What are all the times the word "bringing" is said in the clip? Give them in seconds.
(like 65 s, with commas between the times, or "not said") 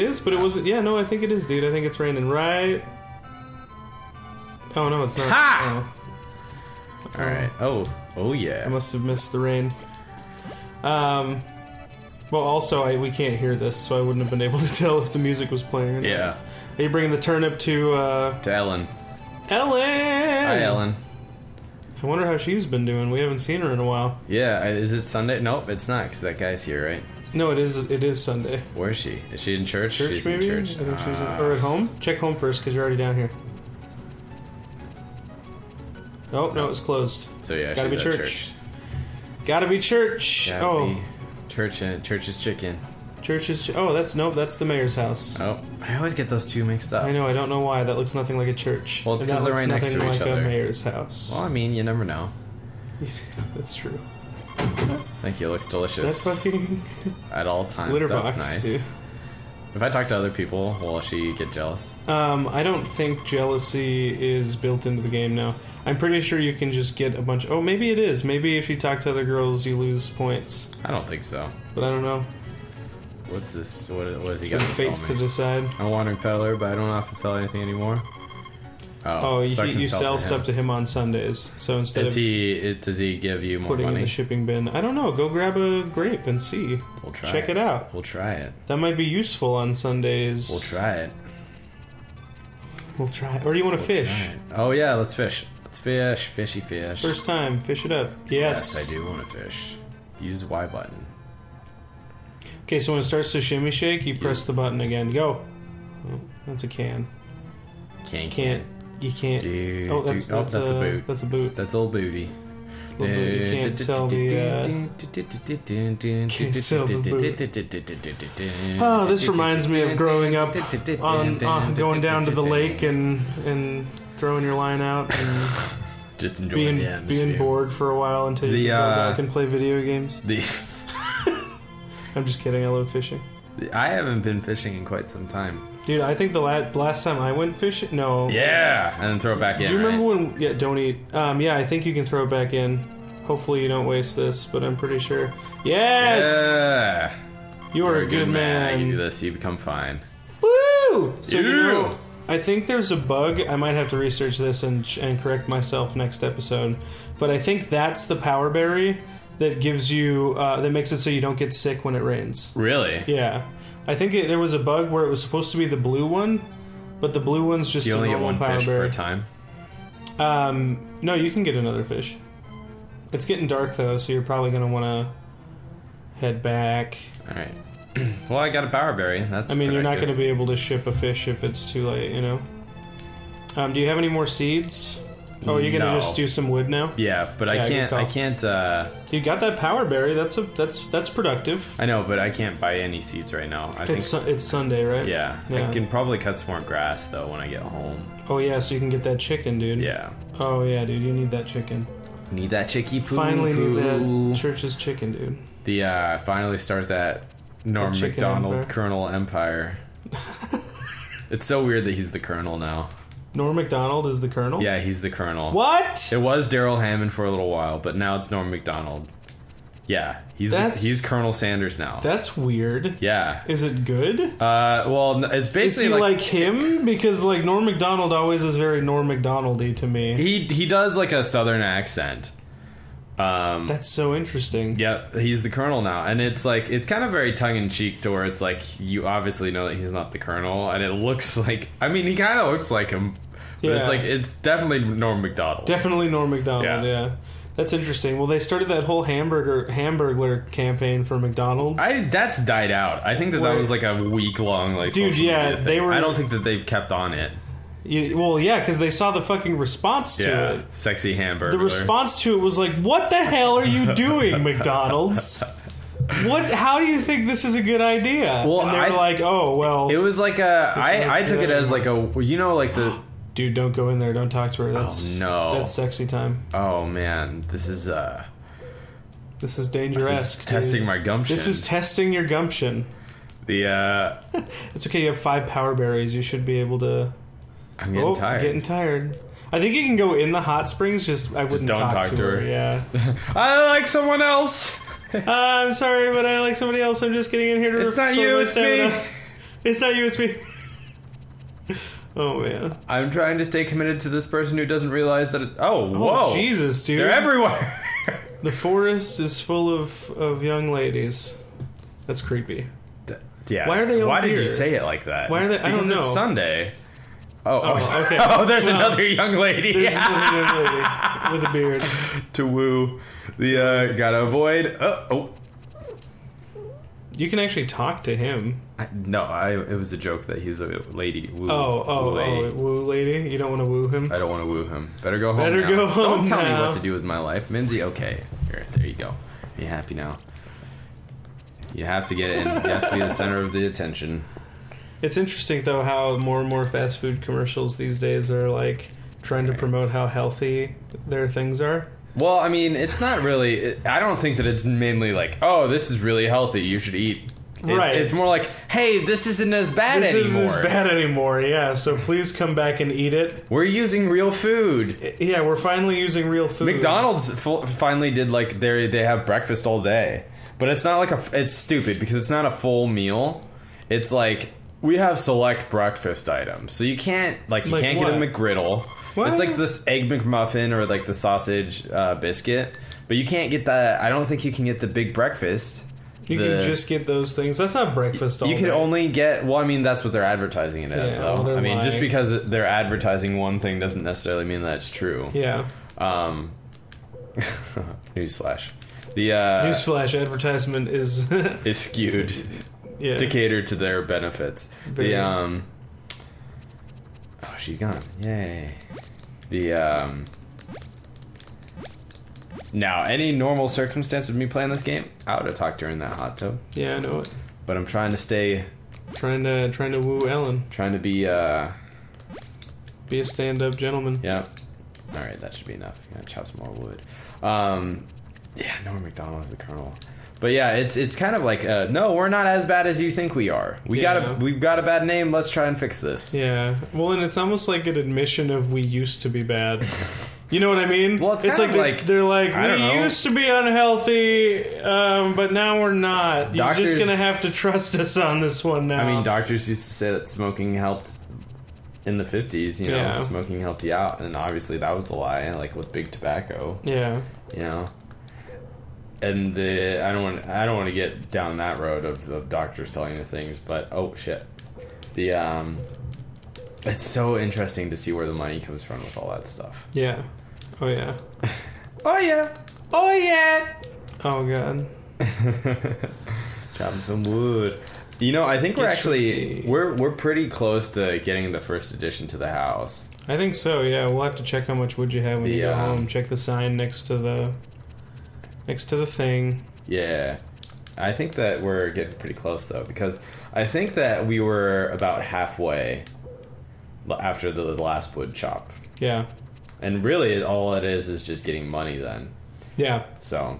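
16 s.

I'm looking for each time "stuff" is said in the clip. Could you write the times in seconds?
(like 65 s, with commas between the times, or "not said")
80 s, 469 s.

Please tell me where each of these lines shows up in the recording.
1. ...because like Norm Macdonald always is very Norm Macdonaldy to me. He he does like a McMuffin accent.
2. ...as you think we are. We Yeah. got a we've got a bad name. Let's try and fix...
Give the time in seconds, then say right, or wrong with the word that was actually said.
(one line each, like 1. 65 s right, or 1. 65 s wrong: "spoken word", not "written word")
1. 226 s wrong: "Southern", not "McMuffin"
2. 432 s right.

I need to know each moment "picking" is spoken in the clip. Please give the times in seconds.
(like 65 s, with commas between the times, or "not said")
not said.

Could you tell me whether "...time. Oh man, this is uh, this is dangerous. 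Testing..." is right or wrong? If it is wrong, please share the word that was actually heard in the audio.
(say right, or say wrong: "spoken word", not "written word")
right.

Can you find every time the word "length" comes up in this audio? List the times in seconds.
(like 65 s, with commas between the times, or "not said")
not said.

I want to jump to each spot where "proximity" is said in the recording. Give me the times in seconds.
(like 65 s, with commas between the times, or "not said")
not said.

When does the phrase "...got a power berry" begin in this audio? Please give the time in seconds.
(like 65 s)
178 s.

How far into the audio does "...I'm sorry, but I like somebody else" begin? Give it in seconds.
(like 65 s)
295 s.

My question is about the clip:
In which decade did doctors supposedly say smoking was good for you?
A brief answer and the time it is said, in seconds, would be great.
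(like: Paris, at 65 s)
the fifties, at 452 s.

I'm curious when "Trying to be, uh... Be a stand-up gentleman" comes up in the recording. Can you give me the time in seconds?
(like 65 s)
420 s.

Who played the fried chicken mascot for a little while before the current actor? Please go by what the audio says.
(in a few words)
Darrell Hammond.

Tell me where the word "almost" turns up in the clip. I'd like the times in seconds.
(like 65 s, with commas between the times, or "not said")
437 s.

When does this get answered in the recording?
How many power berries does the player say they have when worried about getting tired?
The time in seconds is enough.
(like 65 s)
285 s.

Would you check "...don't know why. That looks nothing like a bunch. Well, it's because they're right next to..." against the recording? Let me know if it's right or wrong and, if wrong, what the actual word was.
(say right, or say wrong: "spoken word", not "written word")
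wrong: "church", not "bunch".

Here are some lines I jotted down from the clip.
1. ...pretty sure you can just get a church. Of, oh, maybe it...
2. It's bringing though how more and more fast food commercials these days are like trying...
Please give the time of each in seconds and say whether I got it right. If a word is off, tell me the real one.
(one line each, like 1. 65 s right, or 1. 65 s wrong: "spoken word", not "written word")
1. 65 s wrong: "bunch", not "church"
2. 345 s wrong: "interesting", not "bringing".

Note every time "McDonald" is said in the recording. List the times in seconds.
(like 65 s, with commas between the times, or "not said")
251 s, 264 s, 366 s.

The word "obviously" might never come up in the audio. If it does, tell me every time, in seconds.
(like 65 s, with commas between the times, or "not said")
239 s, 454 s.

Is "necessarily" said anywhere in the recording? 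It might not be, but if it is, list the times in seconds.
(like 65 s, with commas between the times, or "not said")
394 s.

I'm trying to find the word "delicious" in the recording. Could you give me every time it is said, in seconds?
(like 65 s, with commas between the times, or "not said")
55 s.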